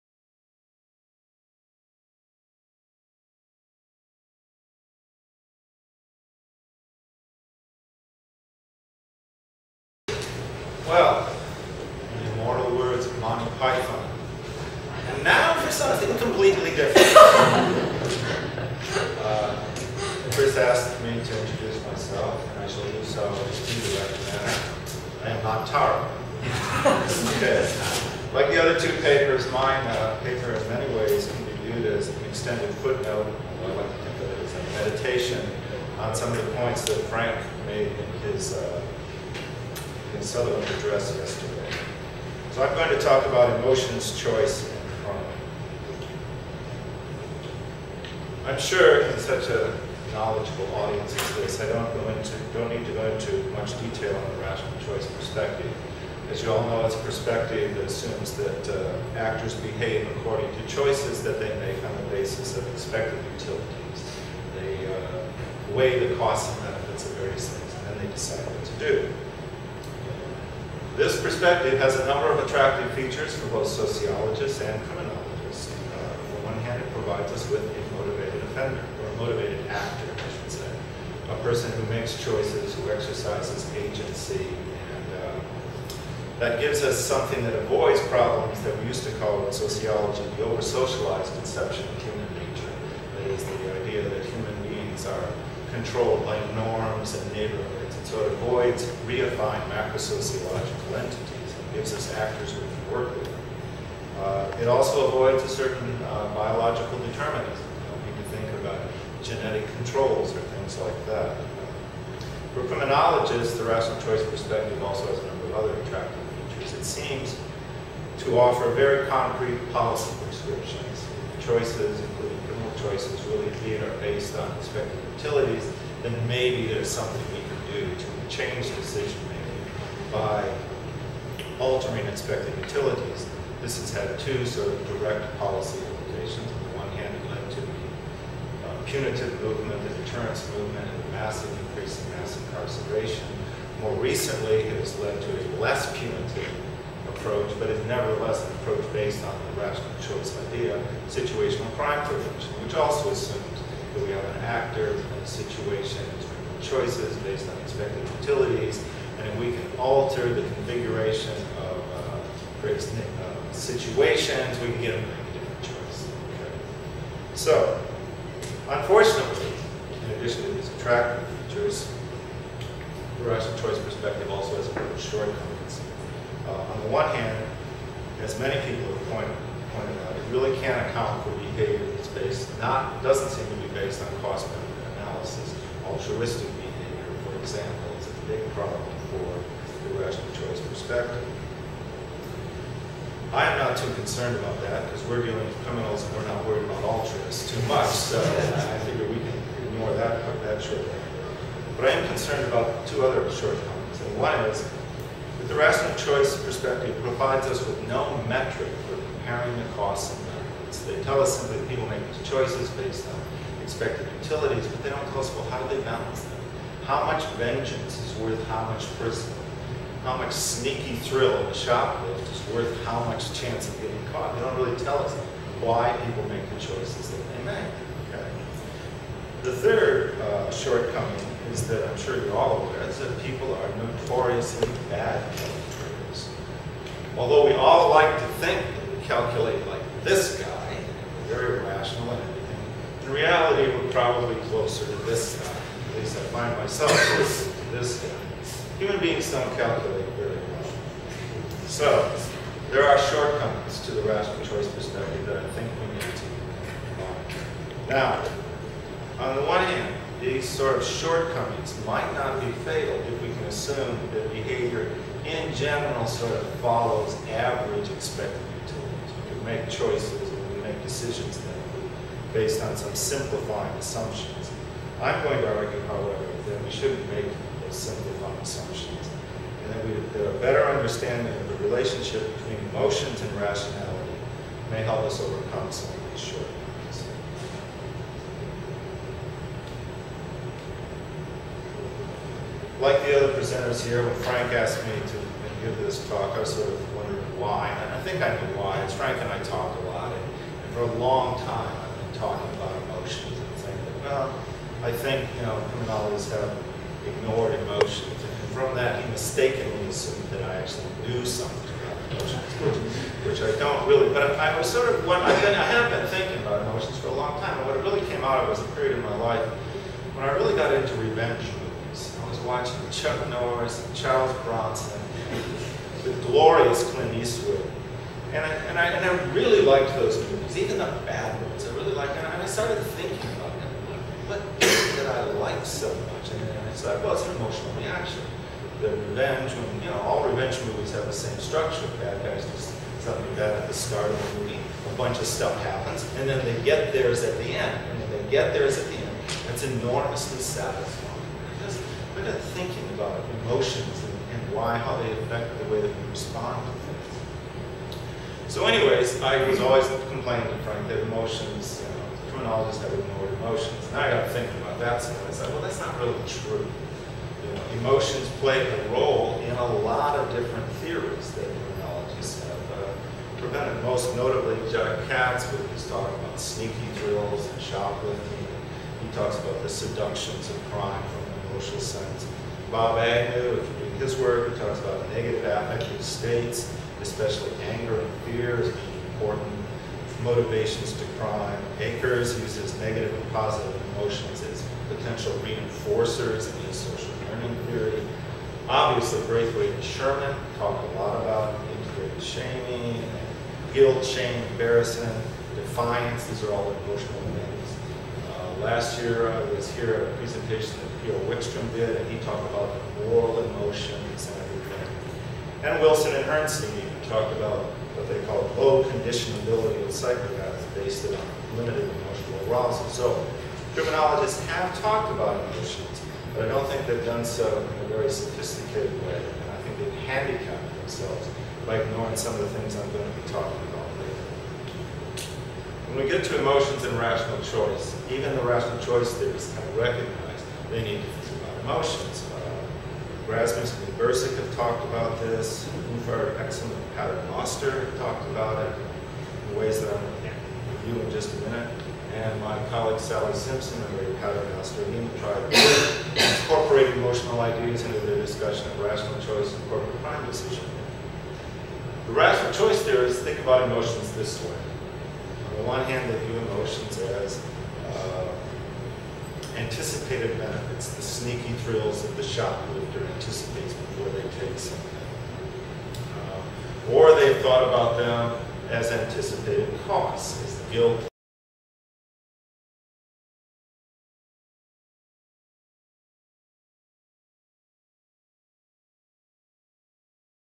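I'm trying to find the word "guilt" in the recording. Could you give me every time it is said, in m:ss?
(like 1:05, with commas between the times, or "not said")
6:43, 8:00.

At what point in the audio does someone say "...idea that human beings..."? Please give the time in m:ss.
1:33.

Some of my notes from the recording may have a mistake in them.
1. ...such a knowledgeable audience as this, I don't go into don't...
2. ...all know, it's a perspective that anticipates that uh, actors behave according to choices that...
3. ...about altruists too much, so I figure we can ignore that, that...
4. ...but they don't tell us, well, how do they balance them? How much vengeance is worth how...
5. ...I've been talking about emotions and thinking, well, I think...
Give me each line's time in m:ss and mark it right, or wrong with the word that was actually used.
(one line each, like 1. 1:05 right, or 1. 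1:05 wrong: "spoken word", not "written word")
1. 0:49 right
2. 0:56 wrong: "assumes", not "anticipates"
3. 3:16 right
4. 3:34 right
5. 5:01 right.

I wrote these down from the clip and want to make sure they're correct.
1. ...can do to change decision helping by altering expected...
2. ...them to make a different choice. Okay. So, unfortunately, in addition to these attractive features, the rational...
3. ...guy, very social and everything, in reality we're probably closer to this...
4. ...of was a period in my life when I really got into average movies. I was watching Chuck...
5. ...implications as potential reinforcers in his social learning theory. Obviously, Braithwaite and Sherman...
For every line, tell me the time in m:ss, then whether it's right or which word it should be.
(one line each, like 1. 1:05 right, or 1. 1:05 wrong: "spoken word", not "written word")
1. 2:07 wrong: "making", not "helping"
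2. 2:44 right
3. 4:00 wrong: "rational", not "social"
4. 5:18 wrong: "revenge", not "average"
5. 6:33 wrong: "emotions", not "implications".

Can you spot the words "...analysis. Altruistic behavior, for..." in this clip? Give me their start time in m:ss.
3:04.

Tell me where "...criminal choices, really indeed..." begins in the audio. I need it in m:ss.
2:02.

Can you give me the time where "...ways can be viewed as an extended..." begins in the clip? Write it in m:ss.
0:30.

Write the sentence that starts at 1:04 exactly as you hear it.
They uh, weigh the costs and benefits of various things, and then they decide what to do.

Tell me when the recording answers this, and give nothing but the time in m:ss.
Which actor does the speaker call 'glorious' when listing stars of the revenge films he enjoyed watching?
5:26.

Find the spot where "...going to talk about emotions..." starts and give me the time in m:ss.
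0:42.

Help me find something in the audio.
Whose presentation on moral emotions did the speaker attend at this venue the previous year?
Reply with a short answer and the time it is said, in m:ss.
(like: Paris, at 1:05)
Peter Wikström, at 6:51.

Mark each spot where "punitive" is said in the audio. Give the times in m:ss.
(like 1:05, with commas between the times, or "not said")
2:18, 2:25.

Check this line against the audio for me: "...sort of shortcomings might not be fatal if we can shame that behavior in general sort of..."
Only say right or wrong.
wrong.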